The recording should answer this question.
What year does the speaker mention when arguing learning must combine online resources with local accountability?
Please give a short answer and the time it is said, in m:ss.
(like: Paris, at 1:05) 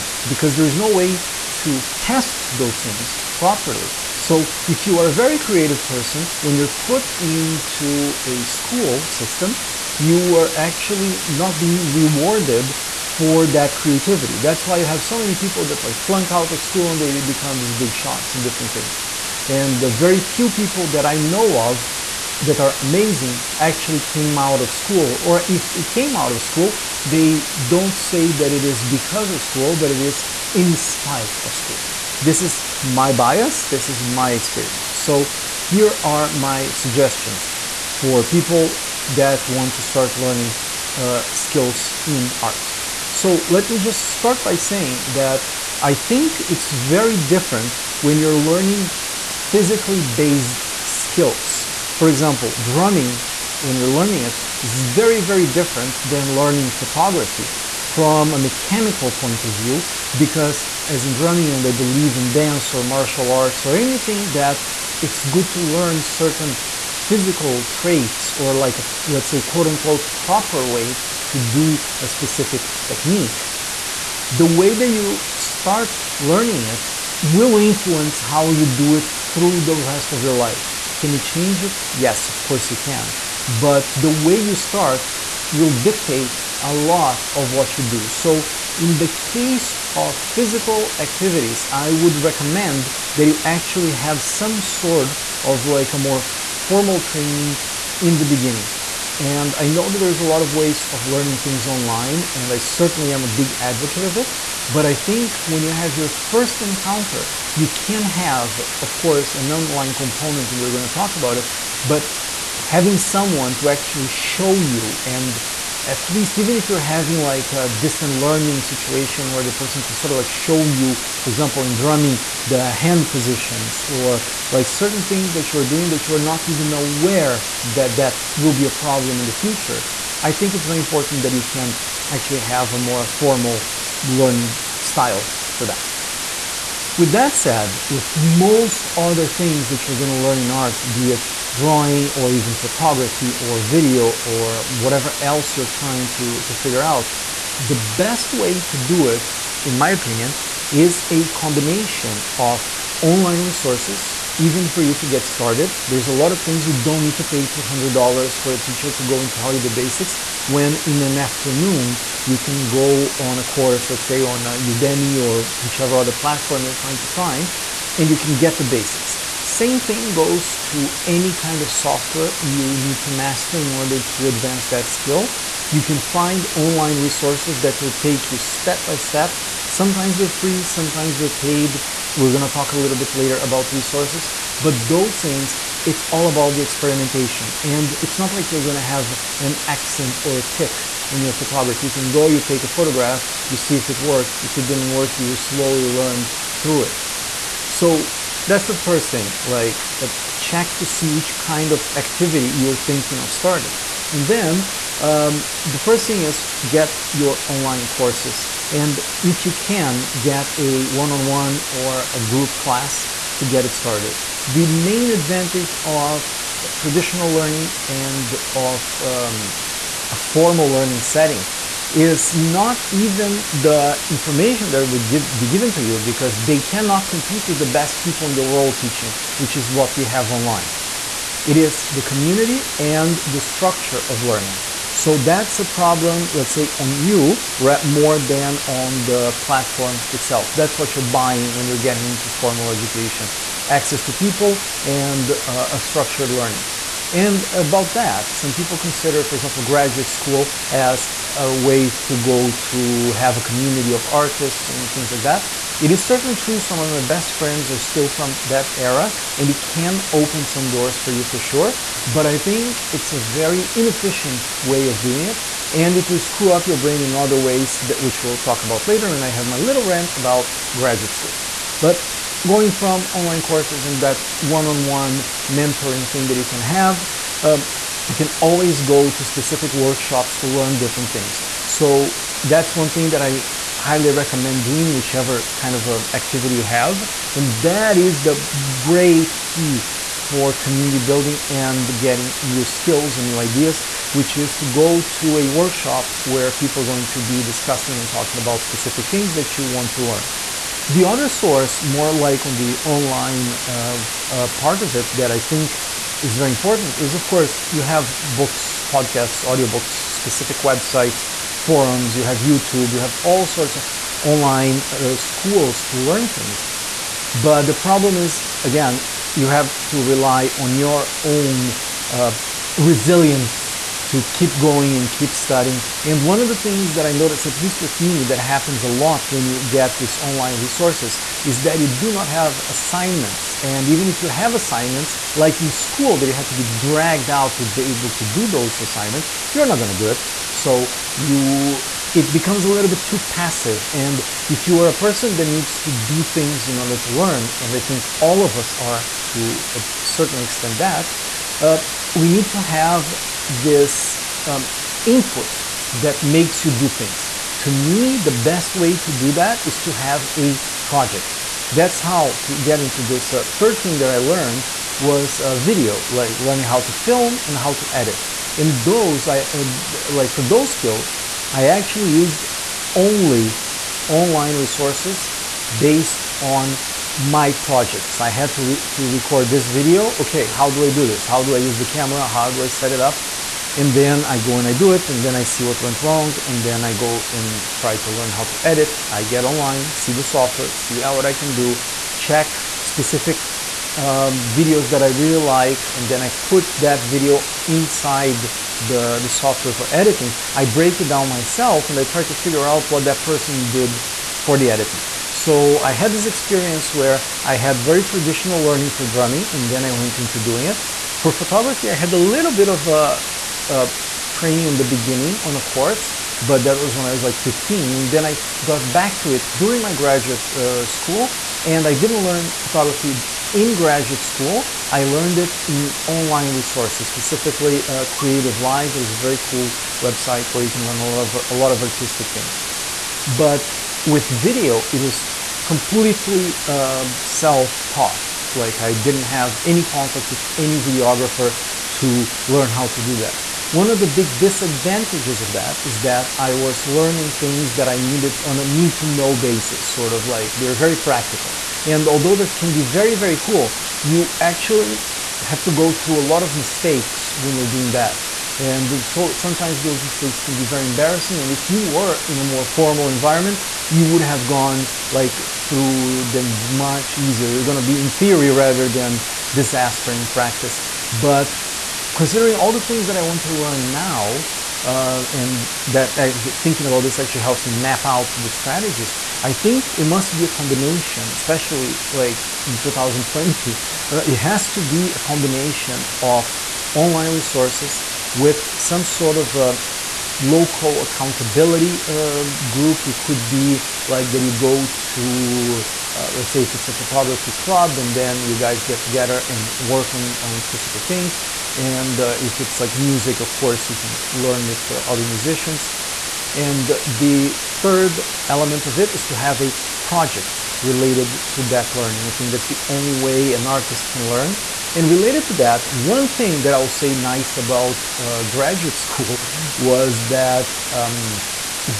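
2020, at 8:02.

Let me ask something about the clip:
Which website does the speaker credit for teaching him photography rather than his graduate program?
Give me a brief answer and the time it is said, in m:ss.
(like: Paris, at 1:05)
Creative Live, at 7:08.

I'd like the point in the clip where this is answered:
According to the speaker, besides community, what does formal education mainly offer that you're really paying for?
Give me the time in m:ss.
3:53.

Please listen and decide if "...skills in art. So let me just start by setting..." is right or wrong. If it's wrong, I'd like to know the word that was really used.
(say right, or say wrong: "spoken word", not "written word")
wrong: "saying", not "setting".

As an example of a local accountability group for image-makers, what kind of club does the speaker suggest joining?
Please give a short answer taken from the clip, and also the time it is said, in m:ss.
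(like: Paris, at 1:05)
photography club, at 8:16.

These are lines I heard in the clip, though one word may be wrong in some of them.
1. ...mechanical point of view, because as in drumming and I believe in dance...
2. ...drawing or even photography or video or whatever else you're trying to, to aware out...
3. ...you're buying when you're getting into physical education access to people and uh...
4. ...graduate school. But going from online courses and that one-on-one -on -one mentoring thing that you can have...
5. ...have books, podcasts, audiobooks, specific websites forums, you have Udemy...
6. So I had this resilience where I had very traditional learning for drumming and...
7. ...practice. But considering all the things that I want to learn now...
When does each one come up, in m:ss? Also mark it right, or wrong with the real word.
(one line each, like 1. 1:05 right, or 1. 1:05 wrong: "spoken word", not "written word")
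1. 0:58 right
2. 2:21 wrong: "figure", not "aware"
3. 4:00 wrong: "formal", not "physical"
4. 4:30 right
5. 5:07 wrong: "YouTube", not "Udemy"
6. 6:45 wrong: "experience", not "resilience"
7. 7:50 right.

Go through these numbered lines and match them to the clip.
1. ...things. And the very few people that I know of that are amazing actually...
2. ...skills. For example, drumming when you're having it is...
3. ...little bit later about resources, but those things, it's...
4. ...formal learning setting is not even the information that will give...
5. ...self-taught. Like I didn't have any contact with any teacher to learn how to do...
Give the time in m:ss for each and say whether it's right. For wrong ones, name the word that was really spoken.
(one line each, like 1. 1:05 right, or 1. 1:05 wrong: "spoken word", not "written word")
1. 0:18 right
2. 0:50 wrong: "learning", not "having"
3. 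3:02 right
4. 3:40 right
5. 7:17 wrong: "videographer", not "teacher".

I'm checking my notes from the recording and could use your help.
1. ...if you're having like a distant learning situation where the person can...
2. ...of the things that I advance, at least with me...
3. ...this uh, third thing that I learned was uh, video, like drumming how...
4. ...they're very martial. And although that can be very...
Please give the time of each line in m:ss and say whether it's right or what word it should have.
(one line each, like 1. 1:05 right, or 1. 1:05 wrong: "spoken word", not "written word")
1. 1:56 right
2. 5:26 wrong: "notice", not "advance"
3. 6:03 wrong: "learning", not "drumming"
4. 7:30 wrong: "practical", not "martial".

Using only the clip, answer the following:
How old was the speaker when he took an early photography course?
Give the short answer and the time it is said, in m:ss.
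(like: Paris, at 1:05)
15, at 6:57.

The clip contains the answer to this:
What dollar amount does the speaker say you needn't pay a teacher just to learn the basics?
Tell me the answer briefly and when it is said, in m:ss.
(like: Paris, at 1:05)
$200, at 2:37.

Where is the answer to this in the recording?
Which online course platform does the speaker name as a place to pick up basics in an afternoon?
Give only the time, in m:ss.
2:44.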